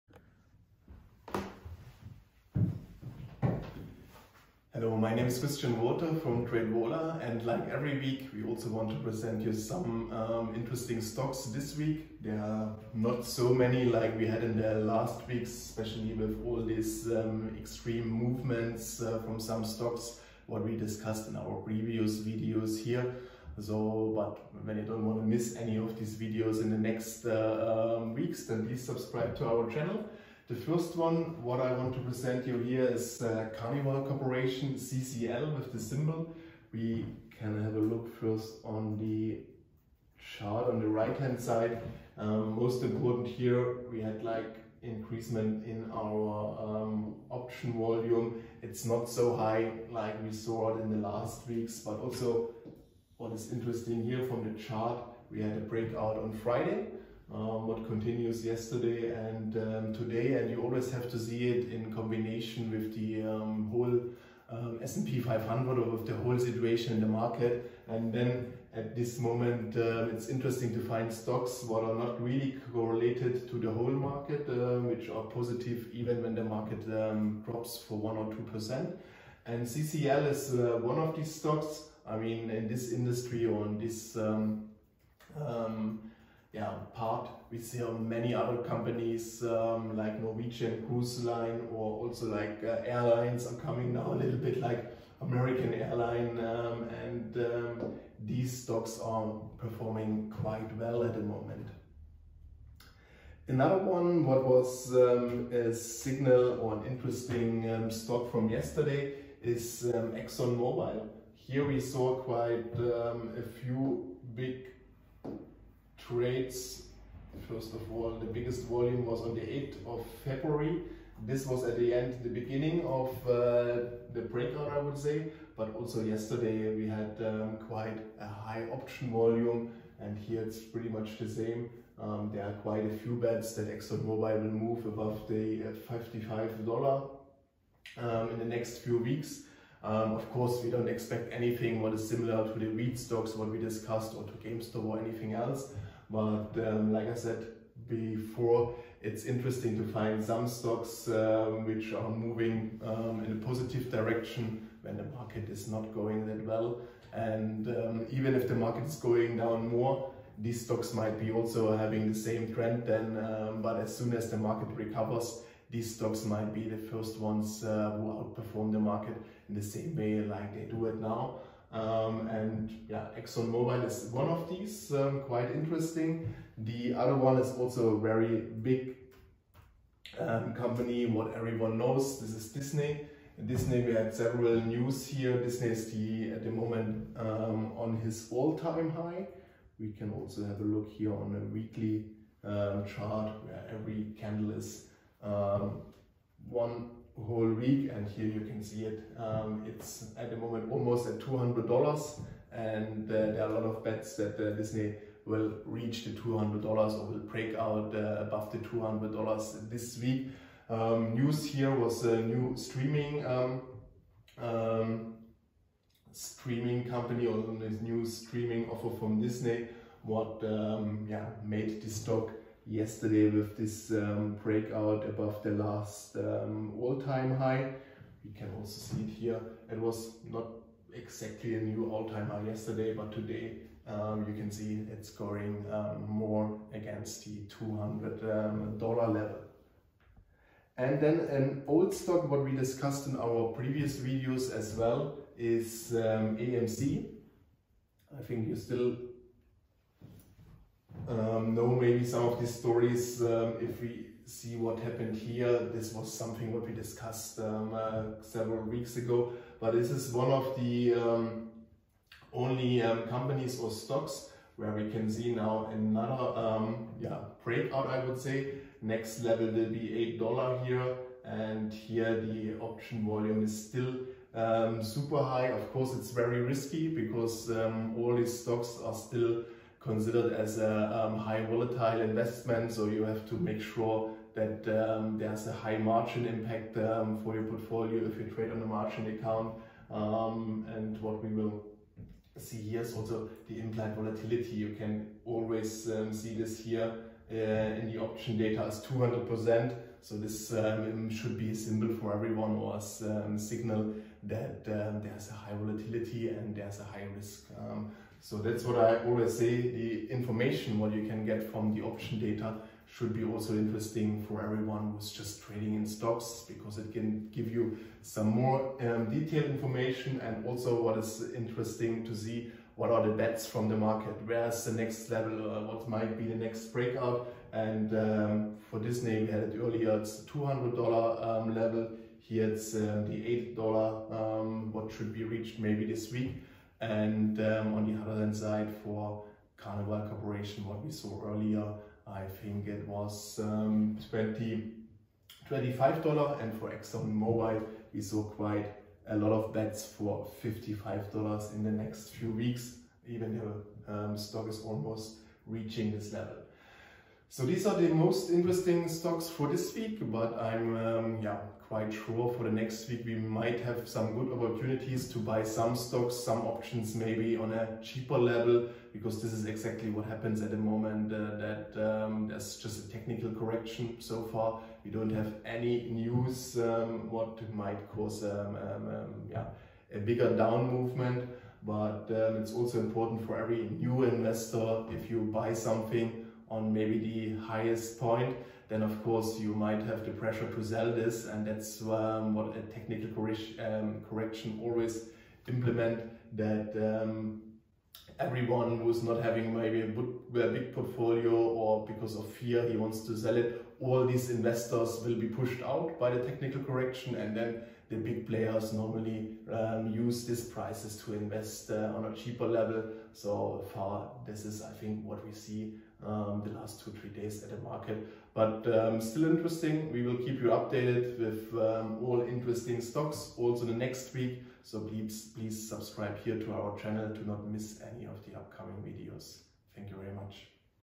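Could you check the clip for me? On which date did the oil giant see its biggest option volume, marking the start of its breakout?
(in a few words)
8th of February.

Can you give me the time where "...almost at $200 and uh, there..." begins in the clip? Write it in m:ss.
3:20.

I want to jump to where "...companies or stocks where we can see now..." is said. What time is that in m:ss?
4:23.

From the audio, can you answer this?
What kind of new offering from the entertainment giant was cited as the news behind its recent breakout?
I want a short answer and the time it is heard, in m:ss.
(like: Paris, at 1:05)
streaming offer, at 3:38.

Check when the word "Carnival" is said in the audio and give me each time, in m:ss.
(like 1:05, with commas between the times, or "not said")
0:33, 5:39.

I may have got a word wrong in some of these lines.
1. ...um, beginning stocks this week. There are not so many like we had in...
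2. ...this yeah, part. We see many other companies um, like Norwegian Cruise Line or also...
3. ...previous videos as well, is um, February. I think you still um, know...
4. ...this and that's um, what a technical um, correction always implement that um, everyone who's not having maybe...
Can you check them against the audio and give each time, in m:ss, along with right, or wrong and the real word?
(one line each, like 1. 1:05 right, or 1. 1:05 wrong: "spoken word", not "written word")
1. 0:10 wrong: "interesting", not "beginning"
2. 1:23 right
3. 4:03 wrong: "AMC", not "February"
4. 6:30 right.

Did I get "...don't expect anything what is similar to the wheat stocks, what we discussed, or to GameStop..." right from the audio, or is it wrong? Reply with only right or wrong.
right.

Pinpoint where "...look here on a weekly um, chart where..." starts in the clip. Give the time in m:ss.
3:10.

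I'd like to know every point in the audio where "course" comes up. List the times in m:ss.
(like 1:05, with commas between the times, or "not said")
2:20, 4:35, 6:29.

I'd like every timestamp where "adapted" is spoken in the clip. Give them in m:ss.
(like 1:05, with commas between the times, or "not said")
not said.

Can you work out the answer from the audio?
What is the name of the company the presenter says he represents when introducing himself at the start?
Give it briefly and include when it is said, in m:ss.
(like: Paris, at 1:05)
TradeVola, at 0:06.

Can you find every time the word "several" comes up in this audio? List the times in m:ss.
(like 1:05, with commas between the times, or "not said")
3:04, 4:18.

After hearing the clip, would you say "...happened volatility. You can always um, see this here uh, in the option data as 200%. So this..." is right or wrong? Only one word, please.
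wrong.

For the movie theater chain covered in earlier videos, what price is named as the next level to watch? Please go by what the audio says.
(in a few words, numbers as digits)
$8.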